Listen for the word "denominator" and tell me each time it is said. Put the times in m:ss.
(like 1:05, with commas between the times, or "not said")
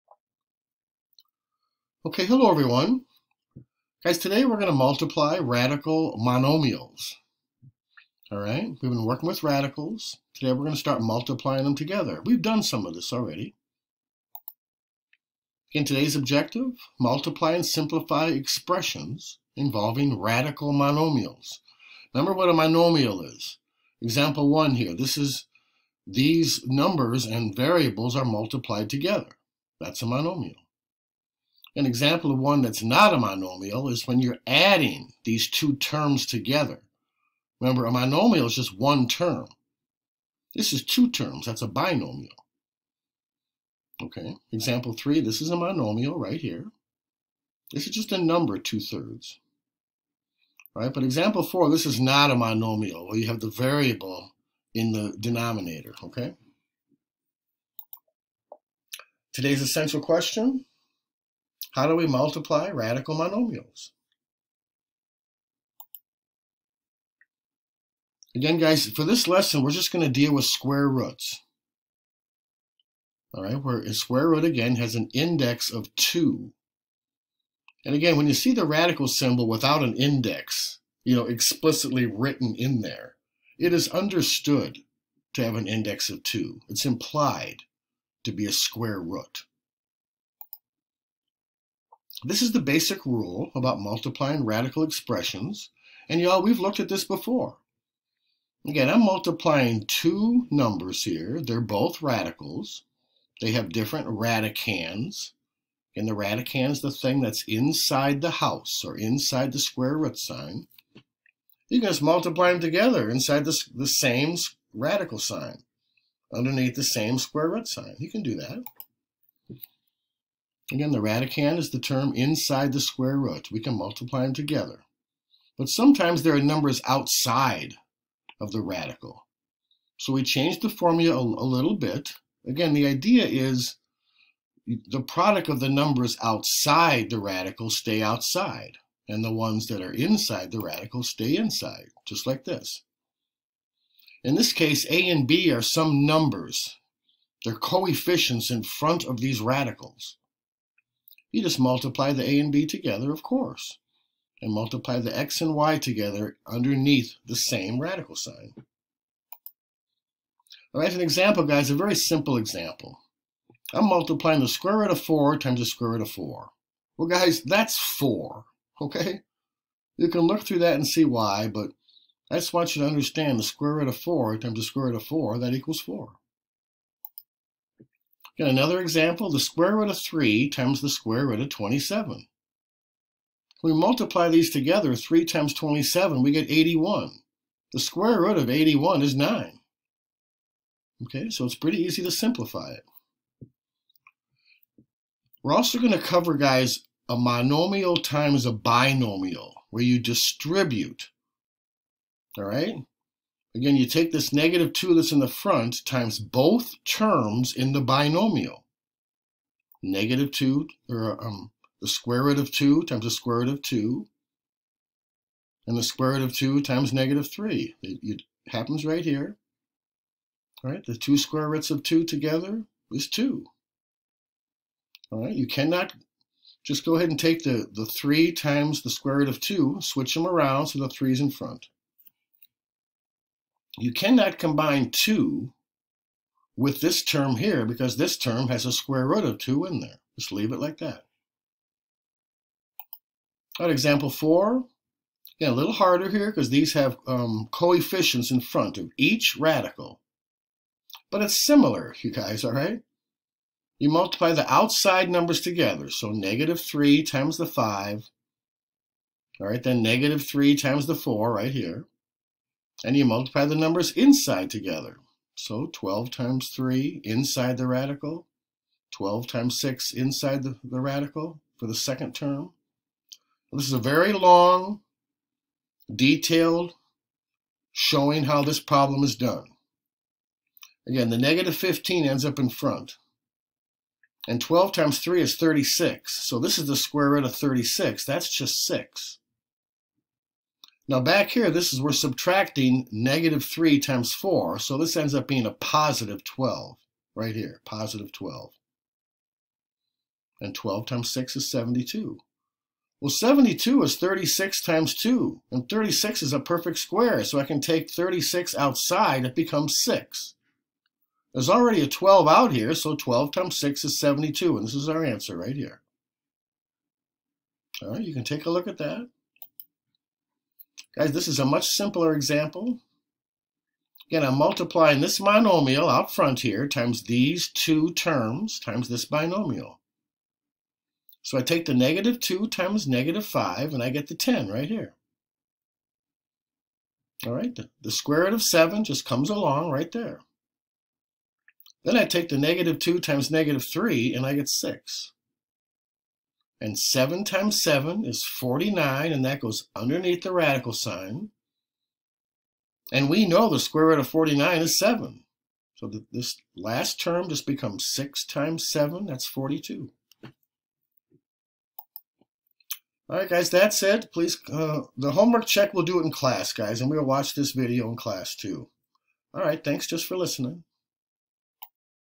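0:55.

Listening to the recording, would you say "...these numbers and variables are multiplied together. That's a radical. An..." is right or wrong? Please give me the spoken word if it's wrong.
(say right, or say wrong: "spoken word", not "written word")
wrong: "monomial", not "radical".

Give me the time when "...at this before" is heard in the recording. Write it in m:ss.
1:36.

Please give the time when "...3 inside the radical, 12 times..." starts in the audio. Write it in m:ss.
4:26.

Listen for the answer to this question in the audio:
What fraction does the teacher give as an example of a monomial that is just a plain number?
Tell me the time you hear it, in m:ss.
0:48.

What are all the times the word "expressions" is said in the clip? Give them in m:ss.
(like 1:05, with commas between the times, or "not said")
0:18, 1:34.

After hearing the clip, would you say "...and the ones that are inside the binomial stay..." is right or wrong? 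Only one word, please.
wrong.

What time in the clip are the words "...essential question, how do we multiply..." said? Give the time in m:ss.
0:59.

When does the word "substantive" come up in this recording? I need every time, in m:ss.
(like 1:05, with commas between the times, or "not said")
not said.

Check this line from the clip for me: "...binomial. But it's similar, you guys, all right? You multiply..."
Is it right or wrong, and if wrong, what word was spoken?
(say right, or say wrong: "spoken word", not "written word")
wrong: "radical", not "binomial".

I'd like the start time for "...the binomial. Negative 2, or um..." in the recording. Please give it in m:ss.
3:27.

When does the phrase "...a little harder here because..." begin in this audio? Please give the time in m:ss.
4:05.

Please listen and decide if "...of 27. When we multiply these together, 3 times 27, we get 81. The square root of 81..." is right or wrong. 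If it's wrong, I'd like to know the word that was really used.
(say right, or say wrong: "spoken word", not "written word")
right.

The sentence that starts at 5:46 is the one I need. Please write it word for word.
And 7 times 7 is 49, and that goes underneath the radical sign.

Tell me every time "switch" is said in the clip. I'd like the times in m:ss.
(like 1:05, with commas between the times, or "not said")
3:49.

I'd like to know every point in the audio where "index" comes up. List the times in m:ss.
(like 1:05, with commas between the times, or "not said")
1:15, 1:19, 1:25.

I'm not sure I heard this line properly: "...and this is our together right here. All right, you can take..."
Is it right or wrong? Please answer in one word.
wrong.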